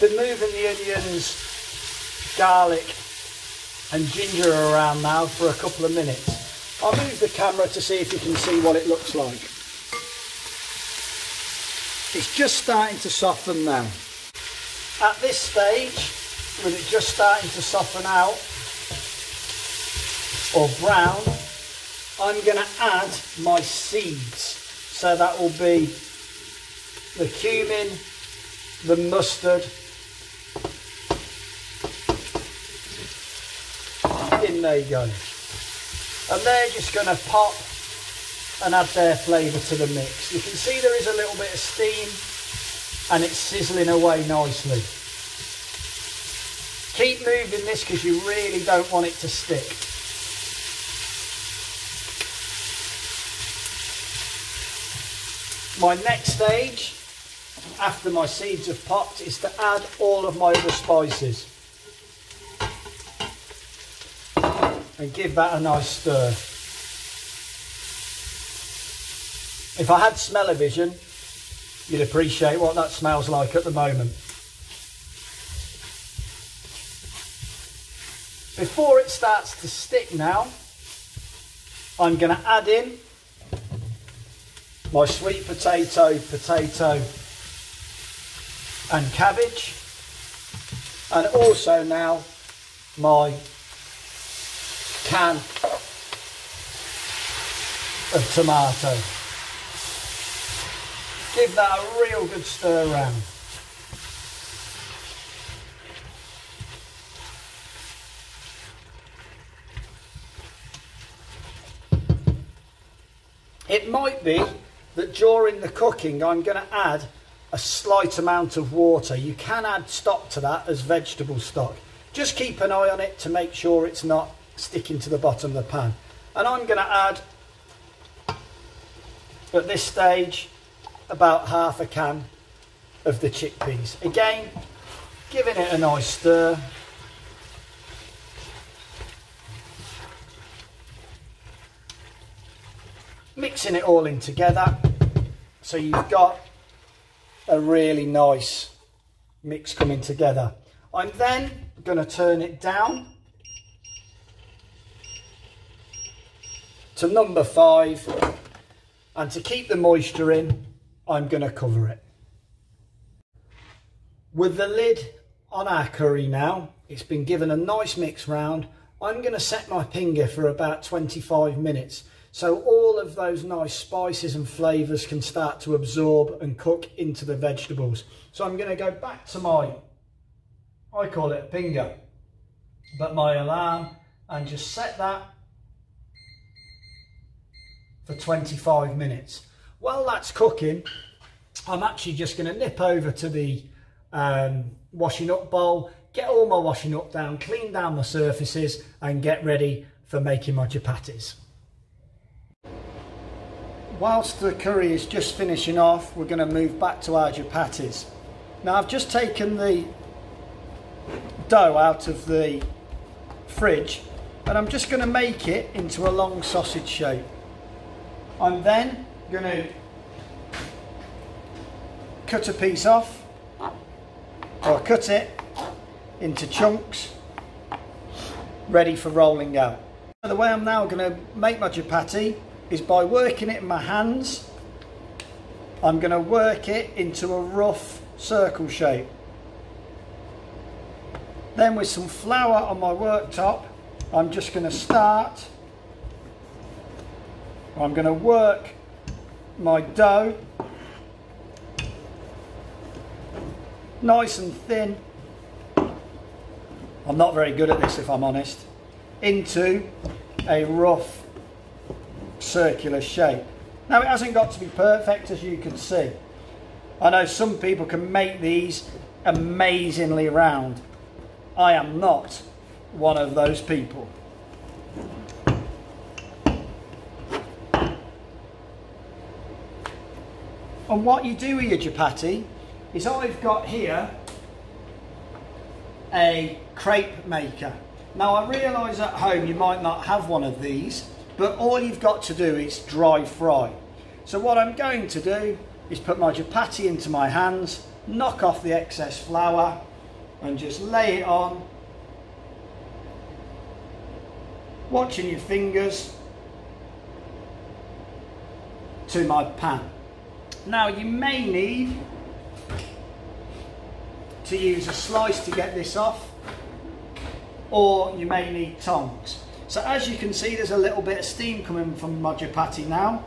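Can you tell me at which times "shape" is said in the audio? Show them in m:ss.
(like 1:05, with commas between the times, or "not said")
3:36, 3:58, 4:23.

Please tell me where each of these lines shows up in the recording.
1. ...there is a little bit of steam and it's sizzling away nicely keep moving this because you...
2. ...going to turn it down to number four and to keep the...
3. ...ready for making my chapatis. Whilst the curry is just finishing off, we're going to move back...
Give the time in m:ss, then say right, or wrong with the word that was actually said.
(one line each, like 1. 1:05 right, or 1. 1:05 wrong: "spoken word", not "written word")
1. 0:40 right
2. 2:31 wrong: "five", not "four"
3. 3:19 right.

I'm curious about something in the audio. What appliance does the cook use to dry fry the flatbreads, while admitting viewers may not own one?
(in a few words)
crepe maker.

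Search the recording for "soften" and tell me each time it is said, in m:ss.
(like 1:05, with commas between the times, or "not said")
0:13, 0:17.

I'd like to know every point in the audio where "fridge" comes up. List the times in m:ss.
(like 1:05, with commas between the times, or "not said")
3:33.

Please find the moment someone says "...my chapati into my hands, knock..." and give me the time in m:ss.
4:56.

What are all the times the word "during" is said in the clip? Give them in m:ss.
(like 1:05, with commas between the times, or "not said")
1:55.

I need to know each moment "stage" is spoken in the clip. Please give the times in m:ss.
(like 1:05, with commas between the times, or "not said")
0:15, 0:56, 2:09.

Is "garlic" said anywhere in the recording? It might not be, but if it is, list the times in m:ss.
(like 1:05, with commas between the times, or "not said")
0:02.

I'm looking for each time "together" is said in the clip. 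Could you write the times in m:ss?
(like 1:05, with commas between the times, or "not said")
2:24, 2:30.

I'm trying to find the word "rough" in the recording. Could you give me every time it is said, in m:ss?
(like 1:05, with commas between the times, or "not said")
3:57, 4:20.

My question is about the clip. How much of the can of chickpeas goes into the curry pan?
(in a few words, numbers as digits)
half a can.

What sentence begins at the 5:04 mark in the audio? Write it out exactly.
Watching your fingers to my pan.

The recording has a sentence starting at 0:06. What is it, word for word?
I'll move the camera to see if you can see what it looks like.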